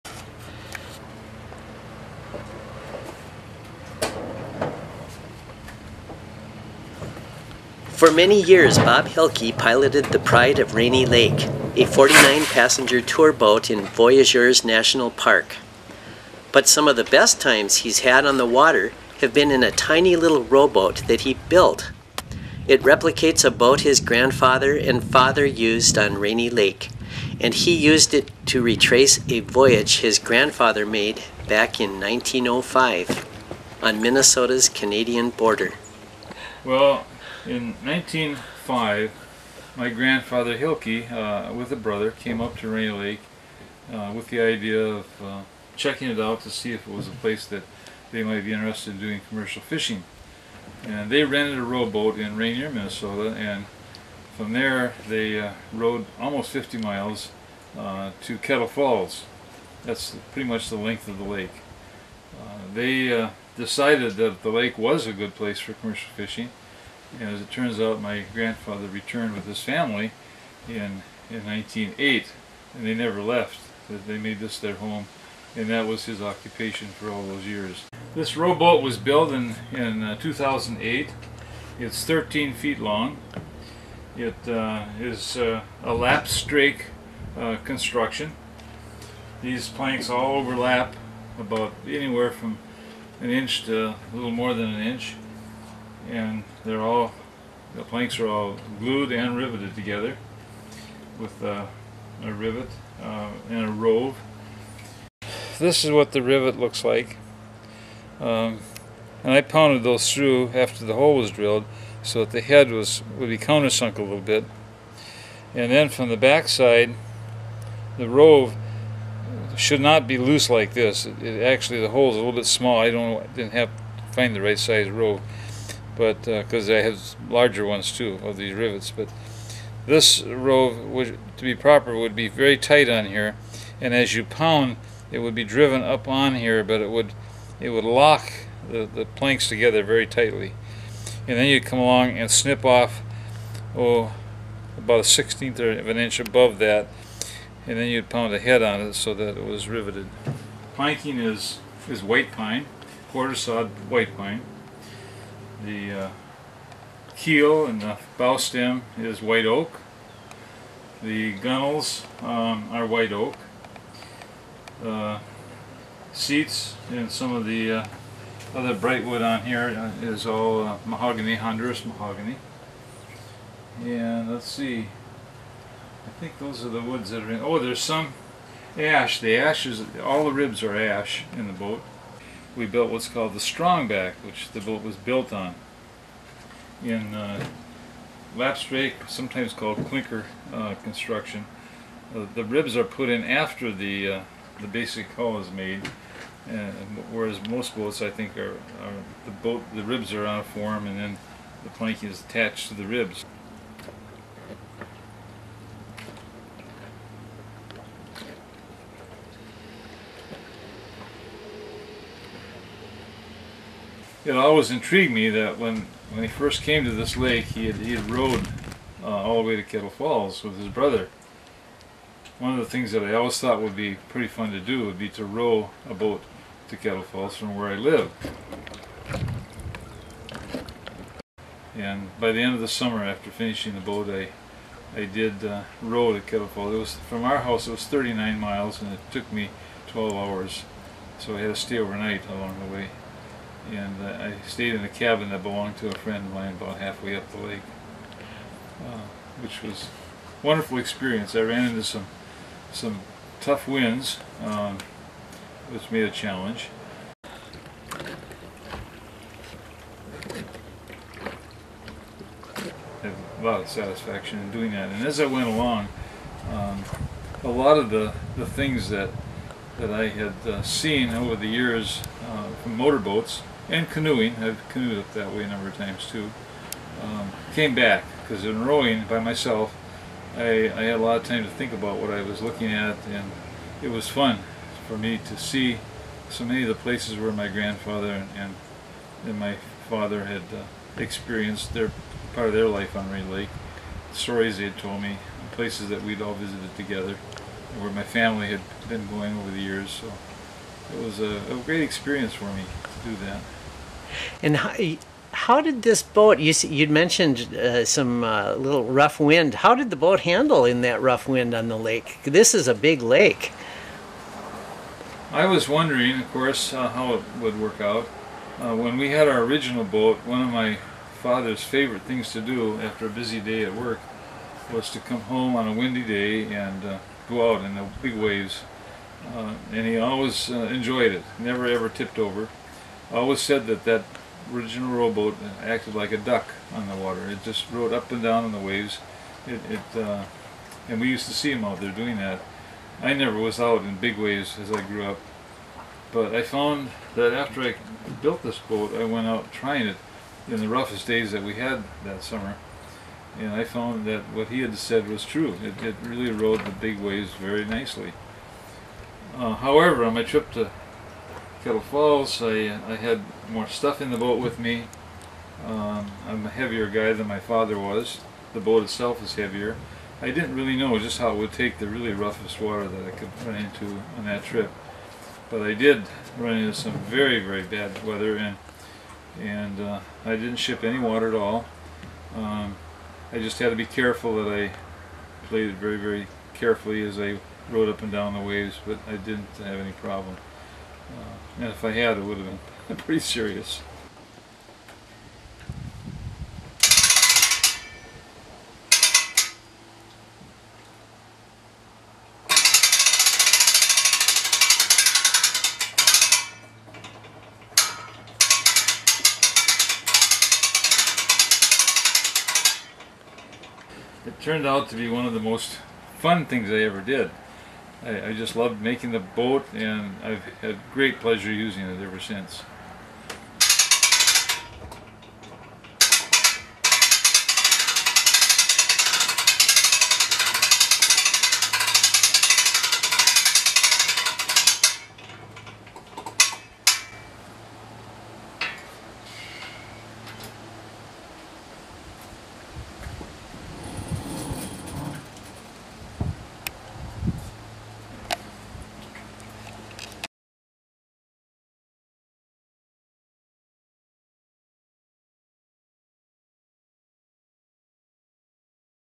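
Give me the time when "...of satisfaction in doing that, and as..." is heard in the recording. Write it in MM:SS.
04:23.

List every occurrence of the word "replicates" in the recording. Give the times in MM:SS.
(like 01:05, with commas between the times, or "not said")
00:22.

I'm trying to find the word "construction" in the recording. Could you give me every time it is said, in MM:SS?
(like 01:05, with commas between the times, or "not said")
01:27, 03:10.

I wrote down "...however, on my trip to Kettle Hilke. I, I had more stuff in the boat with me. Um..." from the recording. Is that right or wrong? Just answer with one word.
wrong.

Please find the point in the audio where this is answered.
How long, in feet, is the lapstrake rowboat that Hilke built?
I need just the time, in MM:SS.
01:22.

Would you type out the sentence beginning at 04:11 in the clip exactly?
I ran into some some tough winds, um, which made a challenge.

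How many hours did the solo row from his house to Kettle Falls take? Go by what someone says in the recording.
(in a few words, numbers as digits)
12 hours.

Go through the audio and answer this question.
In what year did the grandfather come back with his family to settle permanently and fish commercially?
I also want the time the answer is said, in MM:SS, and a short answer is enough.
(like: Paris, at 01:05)
1908, at 01:11.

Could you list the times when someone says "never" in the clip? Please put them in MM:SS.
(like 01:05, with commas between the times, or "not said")
01:12, 05:31, 05:43.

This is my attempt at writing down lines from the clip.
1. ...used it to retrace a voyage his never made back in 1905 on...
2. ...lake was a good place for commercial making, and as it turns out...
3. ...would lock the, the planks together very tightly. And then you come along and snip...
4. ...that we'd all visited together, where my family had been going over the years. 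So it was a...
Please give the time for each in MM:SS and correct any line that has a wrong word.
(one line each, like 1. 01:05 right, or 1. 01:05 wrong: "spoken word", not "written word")
1. 00:27 wrong: "grandfather", not "never"
2. 01:04 wrong: "fishing", not "making"
3. 02:17 right
4. 04:55 right.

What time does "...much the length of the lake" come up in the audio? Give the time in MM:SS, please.
01:00.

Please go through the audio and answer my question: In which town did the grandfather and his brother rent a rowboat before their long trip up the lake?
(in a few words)
Ranier.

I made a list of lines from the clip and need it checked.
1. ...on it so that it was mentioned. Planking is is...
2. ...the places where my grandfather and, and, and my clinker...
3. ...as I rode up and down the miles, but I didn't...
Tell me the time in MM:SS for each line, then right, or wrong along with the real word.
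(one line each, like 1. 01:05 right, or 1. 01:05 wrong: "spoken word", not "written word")
1. 02:28 wrong: "riveted", not "mentioned"
2. 04:46 wrong: "father", not "clinker"
3. 06:27 wrong: "waves", not "miles".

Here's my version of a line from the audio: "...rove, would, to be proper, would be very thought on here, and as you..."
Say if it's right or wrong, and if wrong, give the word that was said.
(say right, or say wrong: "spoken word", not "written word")
wrong: "tight", not "thought".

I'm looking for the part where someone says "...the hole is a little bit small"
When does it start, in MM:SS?
02:01.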